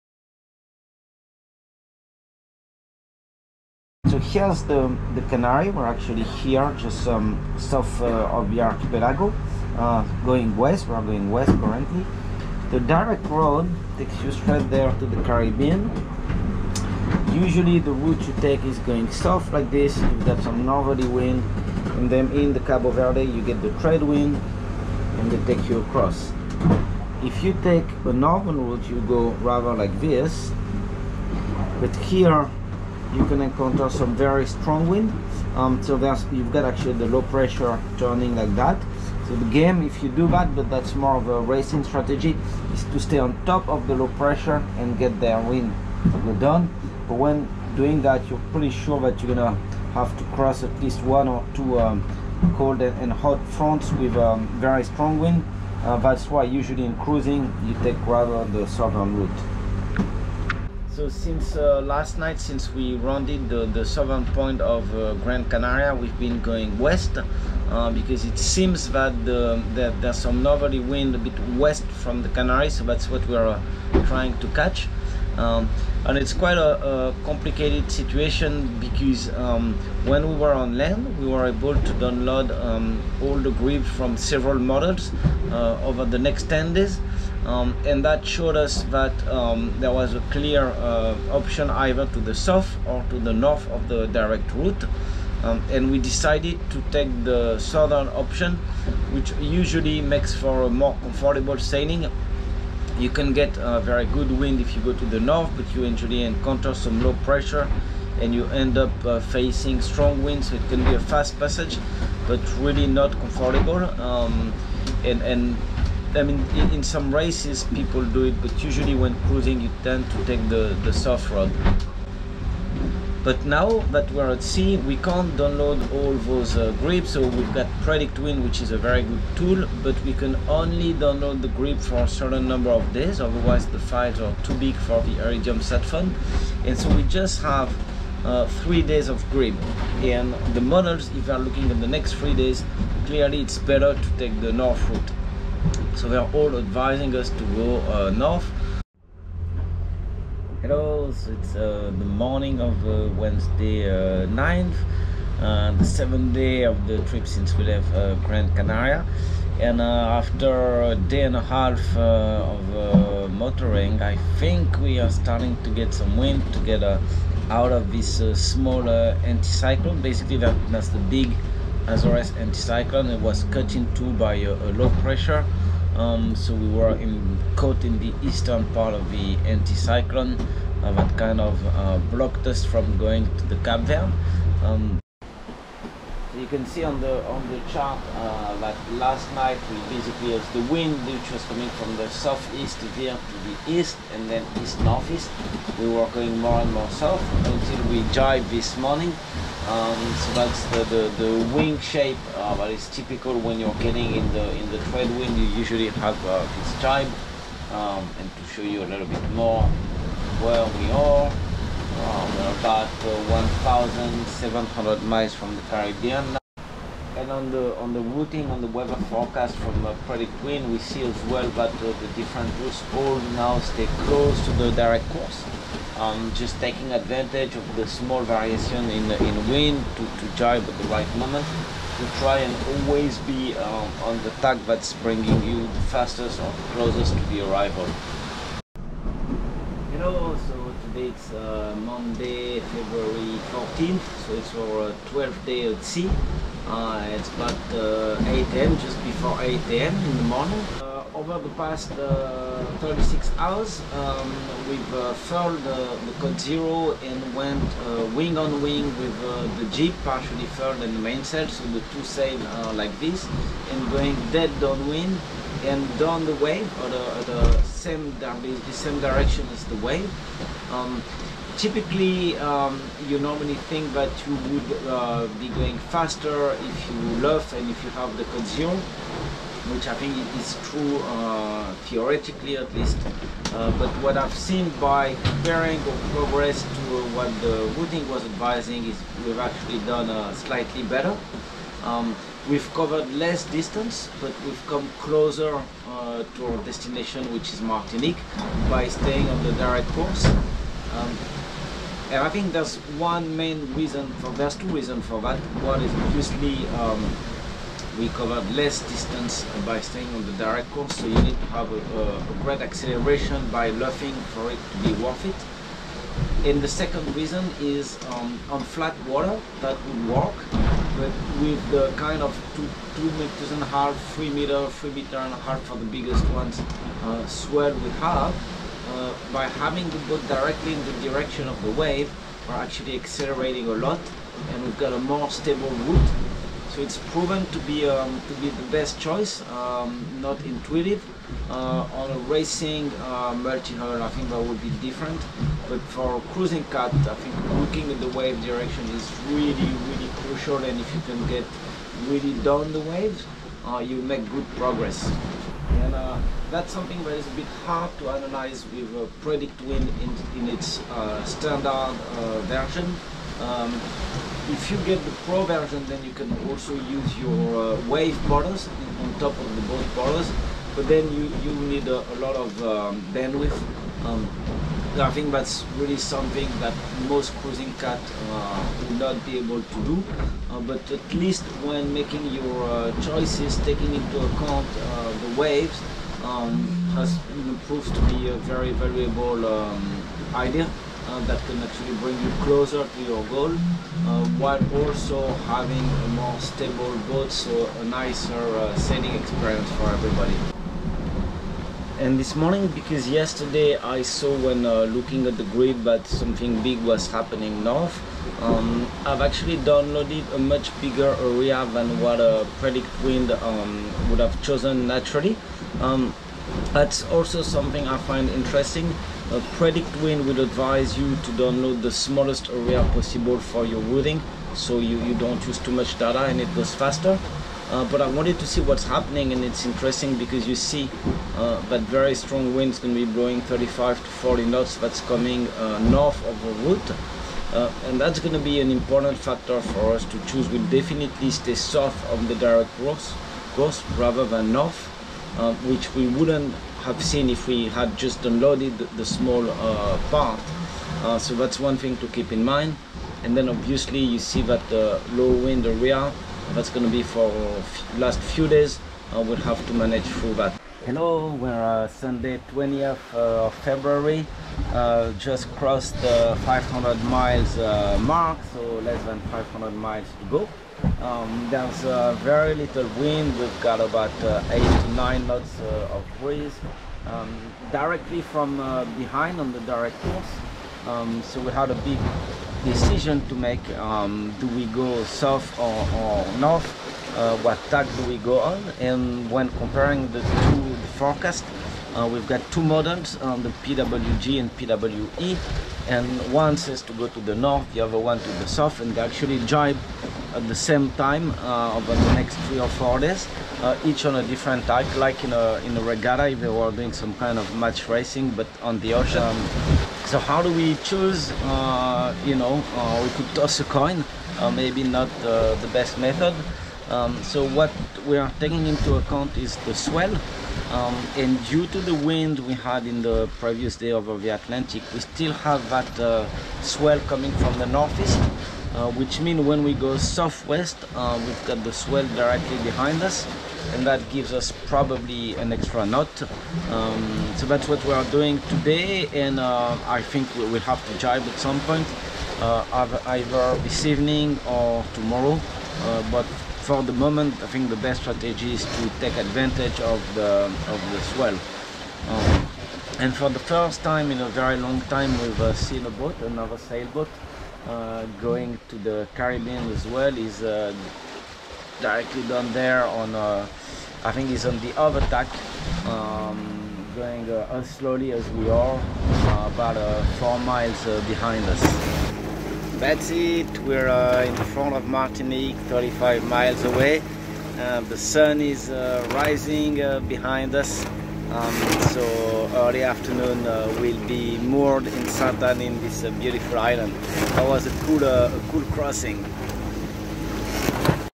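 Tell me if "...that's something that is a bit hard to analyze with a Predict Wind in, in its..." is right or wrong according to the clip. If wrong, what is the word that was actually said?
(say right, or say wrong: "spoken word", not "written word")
right.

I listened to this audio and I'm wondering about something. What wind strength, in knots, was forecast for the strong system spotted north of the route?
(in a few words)
35 to 40 knots.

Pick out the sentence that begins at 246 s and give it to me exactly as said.
Uh, it's about uh, 8 am, just before 8 am in the morning.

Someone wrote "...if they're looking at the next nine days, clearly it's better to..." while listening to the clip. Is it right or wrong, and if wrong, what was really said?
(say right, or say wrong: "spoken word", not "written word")
wrong: "three", not "nine".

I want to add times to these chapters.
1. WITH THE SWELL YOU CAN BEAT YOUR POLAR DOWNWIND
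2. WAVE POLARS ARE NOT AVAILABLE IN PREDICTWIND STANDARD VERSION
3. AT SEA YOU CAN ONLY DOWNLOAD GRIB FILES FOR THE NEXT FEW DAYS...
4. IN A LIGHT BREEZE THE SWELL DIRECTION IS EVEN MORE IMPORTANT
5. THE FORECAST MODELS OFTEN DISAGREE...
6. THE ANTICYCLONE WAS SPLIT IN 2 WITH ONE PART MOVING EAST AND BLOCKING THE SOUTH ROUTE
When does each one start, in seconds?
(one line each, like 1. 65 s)
1. 322 s
2. 356 s
3. 77 s
4. 541 s
5. 462 s
6. 151 s.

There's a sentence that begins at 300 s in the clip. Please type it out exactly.
Um, and I think there's one main reason for, there's two reasons for that.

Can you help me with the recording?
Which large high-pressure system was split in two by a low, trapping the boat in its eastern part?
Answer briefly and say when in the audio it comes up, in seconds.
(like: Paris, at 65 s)
Azores anticyclone, at 171 s.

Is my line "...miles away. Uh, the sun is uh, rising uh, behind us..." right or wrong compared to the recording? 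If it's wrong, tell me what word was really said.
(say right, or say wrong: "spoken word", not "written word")
right.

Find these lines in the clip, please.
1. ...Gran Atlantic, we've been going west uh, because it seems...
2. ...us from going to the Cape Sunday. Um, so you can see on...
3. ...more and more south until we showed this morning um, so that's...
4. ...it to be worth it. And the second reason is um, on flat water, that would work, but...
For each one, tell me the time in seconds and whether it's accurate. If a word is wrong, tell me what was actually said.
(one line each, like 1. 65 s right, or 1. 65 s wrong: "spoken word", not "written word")
1. 65 s wrong: "Canaria", not "Atlantic"
2. 182 s wrong: "Verde", not "Sunday"
3. 196 s wrong: "dived", not "showed"
4. 314 s right.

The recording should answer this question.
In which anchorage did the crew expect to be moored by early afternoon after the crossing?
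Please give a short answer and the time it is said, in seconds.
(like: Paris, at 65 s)
Sainte-Anne, at 585 s.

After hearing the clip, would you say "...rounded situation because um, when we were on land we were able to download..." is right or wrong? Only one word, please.
wrong.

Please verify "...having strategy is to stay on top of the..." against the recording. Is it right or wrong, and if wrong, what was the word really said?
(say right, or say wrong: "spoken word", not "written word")
wrong: "racing", not "having".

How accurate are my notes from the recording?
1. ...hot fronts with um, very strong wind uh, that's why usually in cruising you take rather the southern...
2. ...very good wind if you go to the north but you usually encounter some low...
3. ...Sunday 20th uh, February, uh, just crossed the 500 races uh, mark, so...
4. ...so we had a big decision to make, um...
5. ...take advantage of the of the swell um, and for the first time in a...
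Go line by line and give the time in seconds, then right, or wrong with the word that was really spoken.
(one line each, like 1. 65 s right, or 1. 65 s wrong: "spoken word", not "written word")
1. 53 s right
2. 103 s right
3. 461 s wrong: "miles", not "races"
4. 481 s right
5. 548 s right.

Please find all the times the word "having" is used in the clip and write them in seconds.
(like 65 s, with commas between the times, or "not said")
329 s, 395 s.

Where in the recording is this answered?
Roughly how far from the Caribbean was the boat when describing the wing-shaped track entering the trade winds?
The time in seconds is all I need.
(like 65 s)
213 s.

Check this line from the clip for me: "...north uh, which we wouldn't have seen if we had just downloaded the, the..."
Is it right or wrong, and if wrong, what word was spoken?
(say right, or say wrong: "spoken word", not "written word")
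right.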